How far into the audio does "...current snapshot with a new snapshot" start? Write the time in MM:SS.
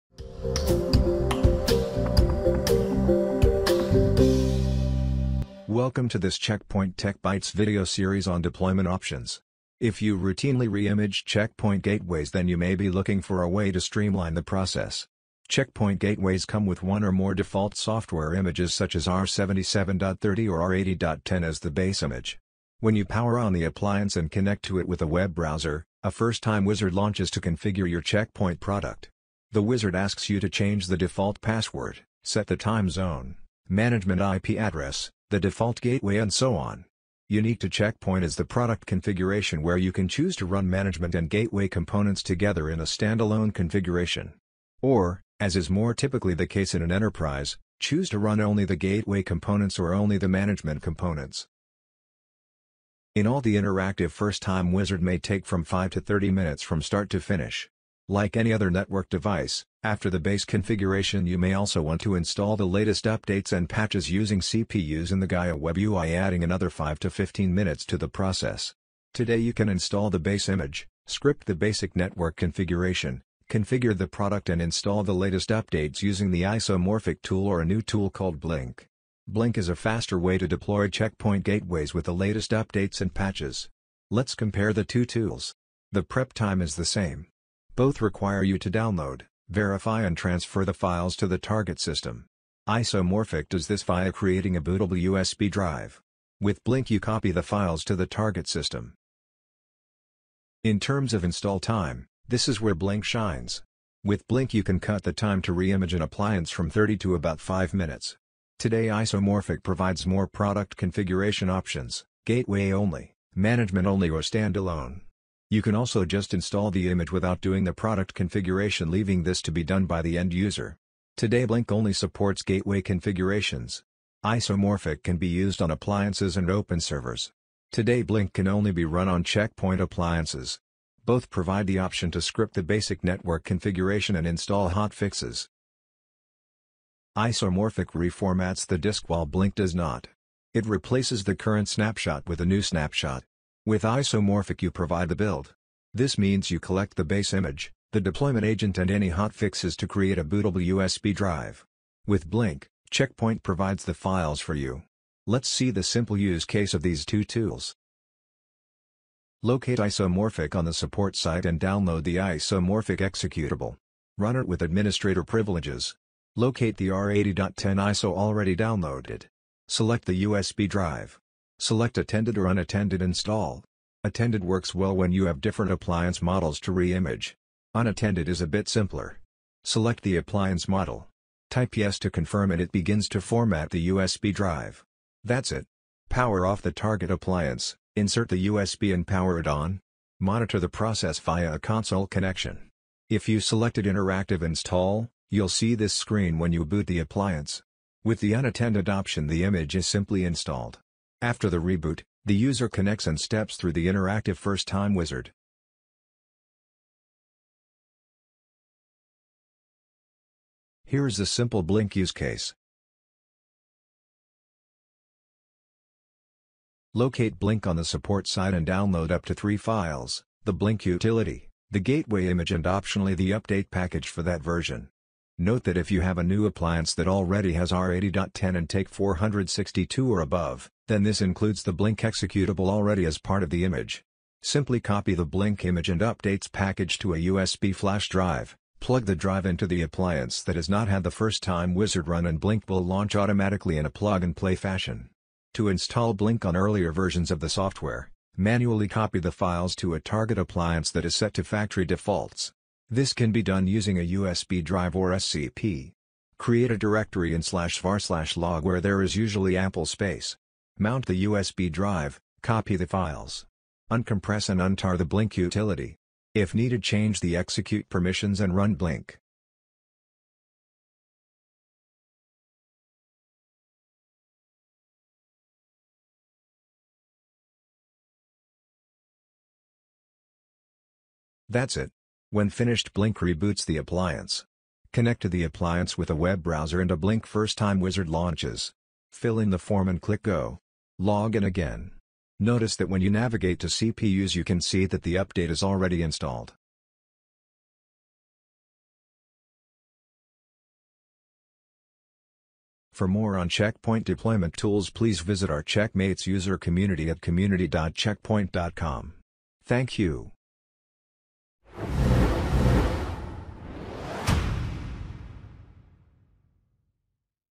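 02:21.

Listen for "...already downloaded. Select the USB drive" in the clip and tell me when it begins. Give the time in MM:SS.
02:48.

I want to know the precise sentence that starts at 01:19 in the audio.
Blink is a faster way to deploy checkpoint gateways with the latest updates and patches.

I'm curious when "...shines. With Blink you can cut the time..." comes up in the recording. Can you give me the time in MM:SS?
01:43.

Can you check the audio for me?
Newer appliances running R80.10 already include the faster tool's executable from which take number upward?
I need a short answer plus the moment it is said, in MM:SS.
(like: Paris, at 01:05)
462, at 03:48.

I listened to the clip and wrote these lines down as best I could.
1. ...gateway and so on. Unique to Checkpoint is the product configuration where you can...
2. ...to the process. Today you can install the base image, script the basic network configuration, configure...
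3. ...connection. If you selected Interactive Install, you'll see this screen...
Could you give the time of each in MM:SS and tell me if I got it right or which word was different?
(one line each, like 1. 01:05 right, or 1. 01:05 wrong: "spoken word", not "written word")
1. 00:35 right
2. 01:07 right
3. 03:12 right.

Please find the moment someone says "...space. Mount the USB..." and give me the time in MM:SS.
04:19.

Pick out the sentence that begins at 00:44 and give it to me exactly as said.
Or, as is more typically the case in an enterprise, choose to run only the gateway components or only the management components.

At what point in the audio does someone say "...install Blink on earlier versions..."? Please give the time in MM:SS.
04:05.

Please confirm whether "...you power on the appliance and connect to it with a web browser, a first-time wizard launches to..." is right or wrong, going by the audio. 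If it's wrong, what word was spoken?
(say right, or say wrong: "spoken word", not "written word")
right.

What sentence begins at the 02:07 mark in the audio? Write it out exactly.
Today Blink can only be run on checkpoint appliances.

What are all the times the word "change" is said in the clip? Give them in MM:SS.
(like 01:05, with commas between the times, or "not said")
00:30, 04:26.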